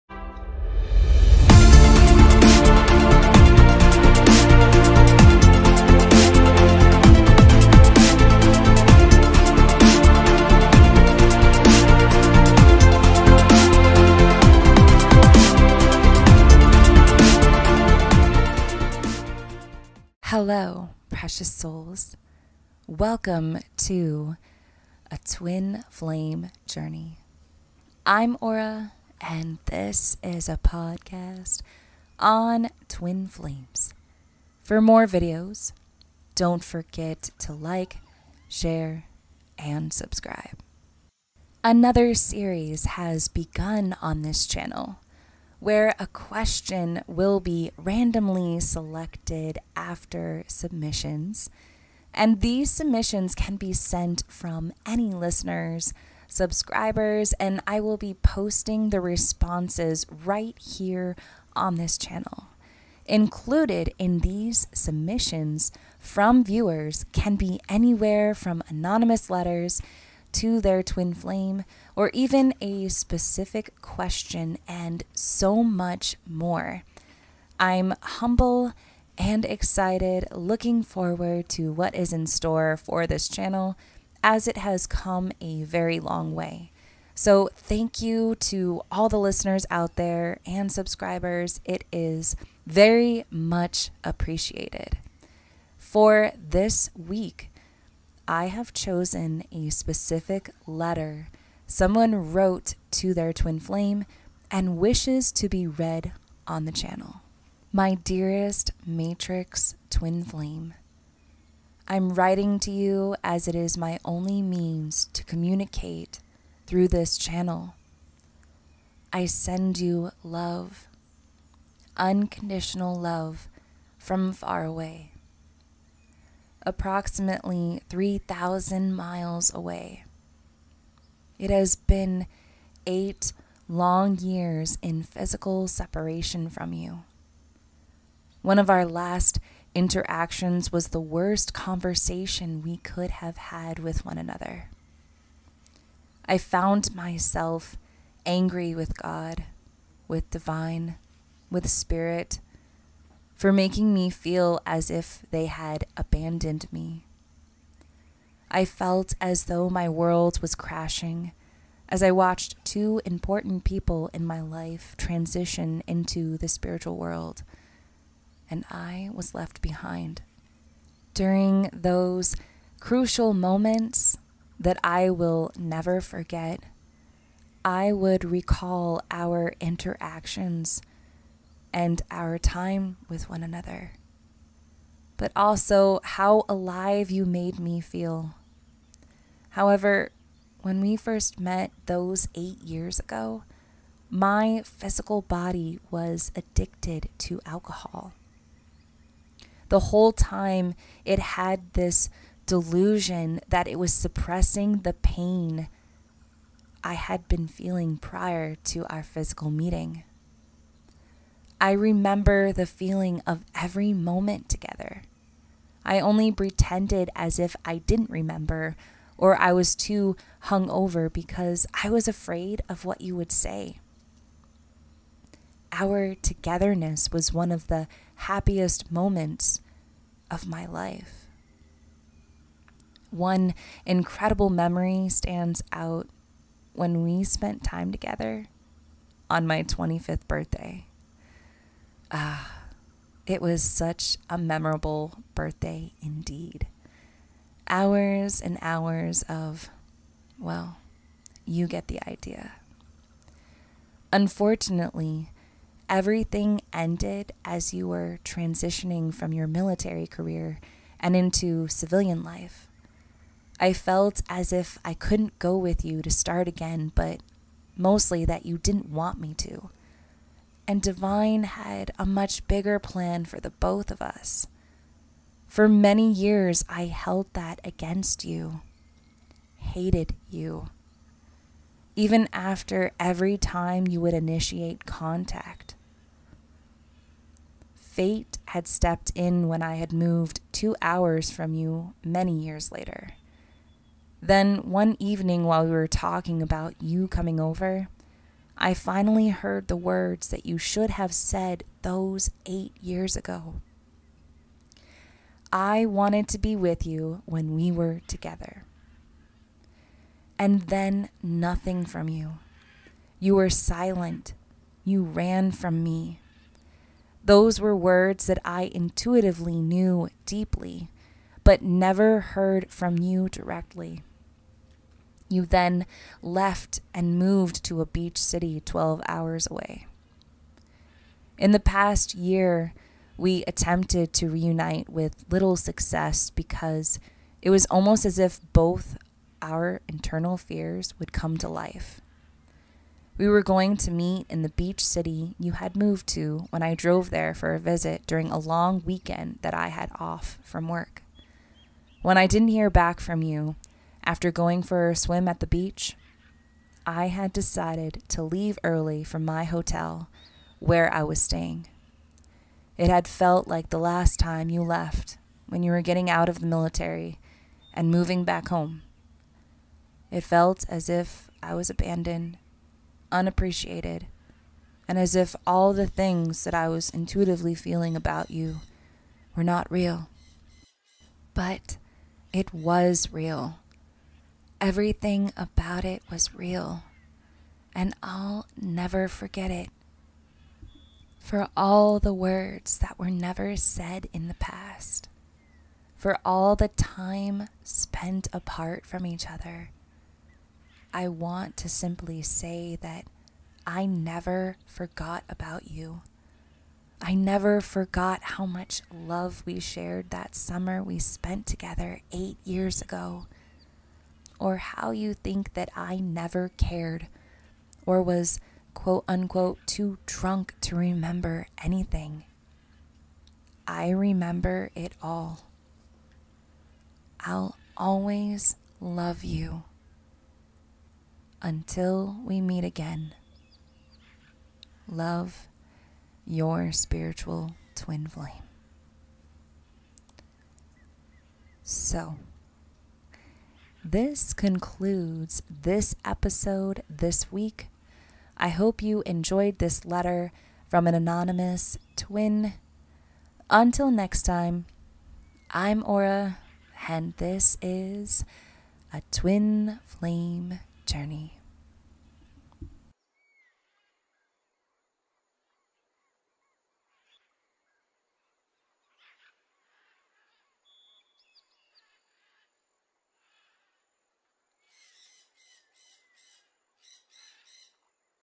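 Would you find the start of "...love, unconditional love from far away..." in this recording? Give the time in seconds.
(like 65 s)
120 s.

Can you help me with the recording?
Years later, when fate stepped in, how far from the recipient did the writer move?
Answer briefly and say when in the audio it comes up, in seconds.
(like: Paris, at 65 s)
2 hours, at 290 s.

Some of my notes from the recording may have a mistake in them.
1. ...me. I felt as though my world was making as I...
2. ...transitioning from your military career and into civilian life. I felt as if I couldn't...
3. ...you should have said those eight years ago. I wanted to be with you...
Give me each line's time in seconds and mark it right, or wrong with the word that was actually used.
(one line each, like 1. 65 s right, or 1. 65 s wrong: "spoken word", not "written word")
1. 156 s wrong: "crashing", not "making"
2. 258 s right
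3. 300 s right.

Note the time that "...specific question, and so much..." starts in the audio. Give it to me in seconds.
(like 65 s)
72 s.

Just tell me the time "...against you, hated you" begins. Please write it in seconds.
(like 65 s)
277 s.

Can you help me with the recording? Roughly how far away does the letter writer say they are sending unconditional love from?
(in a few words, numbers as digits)
3,000 miles.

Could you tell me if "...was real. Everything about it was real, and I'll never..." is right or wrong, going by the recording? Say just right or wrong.
right.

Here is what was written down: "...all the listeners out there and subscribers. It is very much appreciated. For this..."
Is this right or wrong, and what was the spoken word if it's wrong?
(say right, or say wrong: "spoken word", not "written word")
right.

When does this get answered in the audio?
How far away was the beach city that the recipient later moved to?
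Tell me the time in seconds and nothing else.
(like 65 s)
328 s.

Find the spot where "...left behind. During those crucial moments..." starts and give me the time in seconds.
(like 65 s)
169 s.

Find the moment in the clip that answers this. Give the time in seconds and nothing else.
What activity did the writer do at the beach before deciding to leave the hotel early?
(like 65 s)
354 s.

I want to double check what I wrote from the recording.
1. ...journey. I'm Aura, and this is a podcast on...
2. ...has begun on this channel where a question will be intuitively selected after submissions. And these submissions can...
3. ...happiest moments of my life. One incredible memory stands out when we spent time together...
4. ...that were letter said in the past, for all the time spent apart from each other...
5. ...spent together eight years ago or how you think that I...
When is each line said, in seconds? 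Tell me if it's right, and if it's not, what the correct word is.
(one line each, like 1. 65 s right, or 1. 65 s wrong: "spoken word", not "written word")
1. 26 s right
2. 42 s wrong: "randomly", not "intuitively"
3. 228 s right
4. 392 s wrong: "never", not "letter"
5. 410 s right.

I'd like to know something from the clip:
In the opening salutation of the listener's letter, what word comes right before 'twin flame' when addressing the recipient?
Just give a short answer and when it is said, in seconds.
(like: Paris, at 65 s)
Matrix, at 108 s.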